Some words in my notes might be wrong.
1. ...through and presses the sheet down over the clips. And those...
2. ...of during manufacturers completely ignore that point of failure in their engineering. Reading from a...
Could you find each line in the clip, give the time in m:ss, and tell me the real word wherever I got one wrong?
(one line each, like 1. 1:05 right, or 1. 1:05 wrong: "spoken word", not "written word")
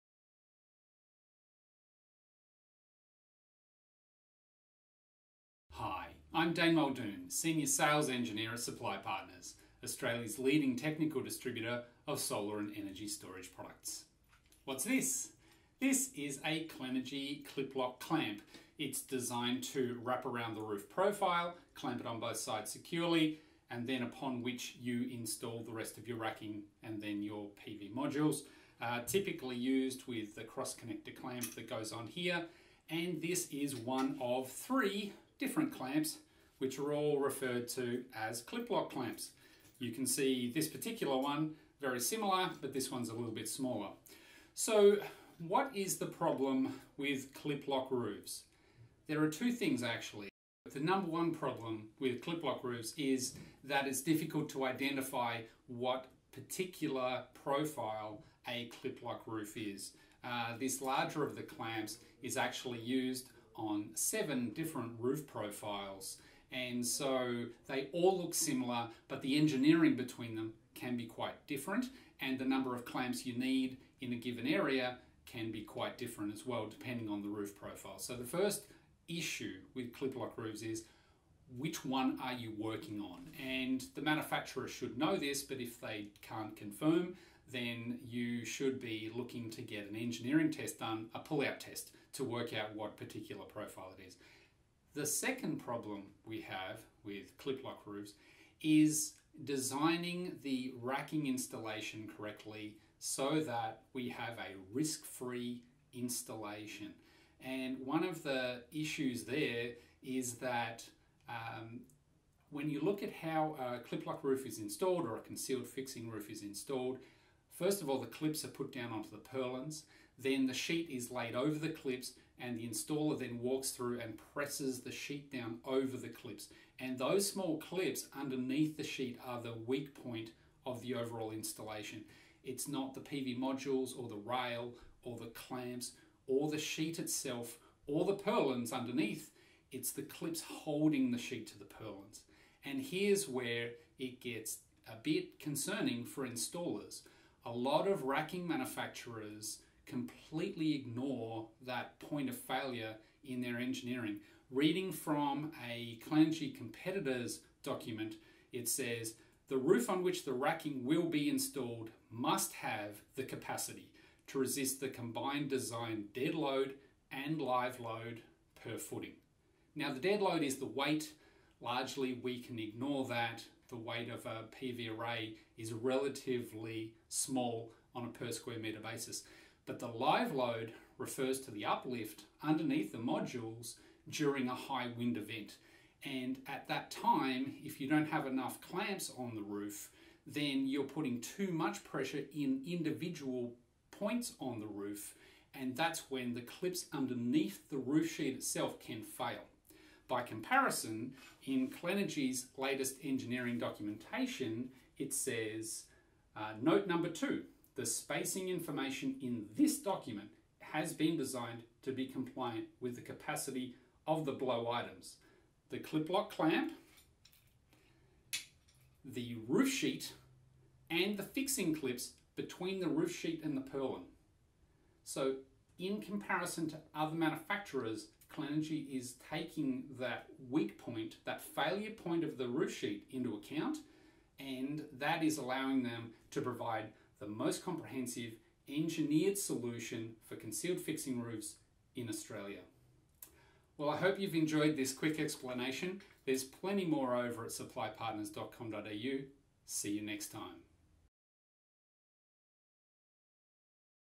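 1. 2:03 right
2. 2:27 wrong: "racking", not "during".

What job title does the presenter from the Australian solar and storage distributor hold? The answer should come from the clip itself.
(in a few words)
Senior Sales Engineer.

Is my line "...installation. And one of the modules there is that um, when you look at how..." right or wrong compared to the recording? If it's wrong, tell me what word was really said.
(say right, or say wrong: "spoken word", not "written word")
wrong: "issues", not "modules".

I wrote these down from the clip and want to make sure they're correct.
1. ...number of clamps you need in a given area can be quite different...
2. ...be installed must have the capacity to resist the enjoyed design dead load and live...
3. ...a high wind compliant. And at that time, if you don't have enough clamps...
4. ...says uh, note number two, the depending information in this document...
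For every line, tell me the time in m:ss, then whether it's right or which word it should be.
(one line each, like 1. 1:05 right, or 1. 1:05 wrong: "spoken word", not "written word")
1. 1:12 right
2. 2:41 wrong: "combined", not "enjoyed"
3. 3:04 wrong: "event", not "compliant"
4. 3:25 wrong: "spacing", not "depending".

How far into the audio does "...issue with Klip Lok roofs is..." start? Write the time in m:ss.
1:19.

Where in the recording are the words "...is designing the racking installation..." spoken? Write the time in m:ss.
1:38.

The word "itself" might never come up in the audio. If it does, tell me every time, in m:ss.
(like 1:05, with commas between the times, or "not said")
2:16, 3:18.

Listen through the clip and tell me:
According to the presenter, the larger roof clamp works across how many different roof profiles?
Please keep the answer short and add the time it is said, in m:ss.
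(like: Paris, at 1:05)
7, at 1:03.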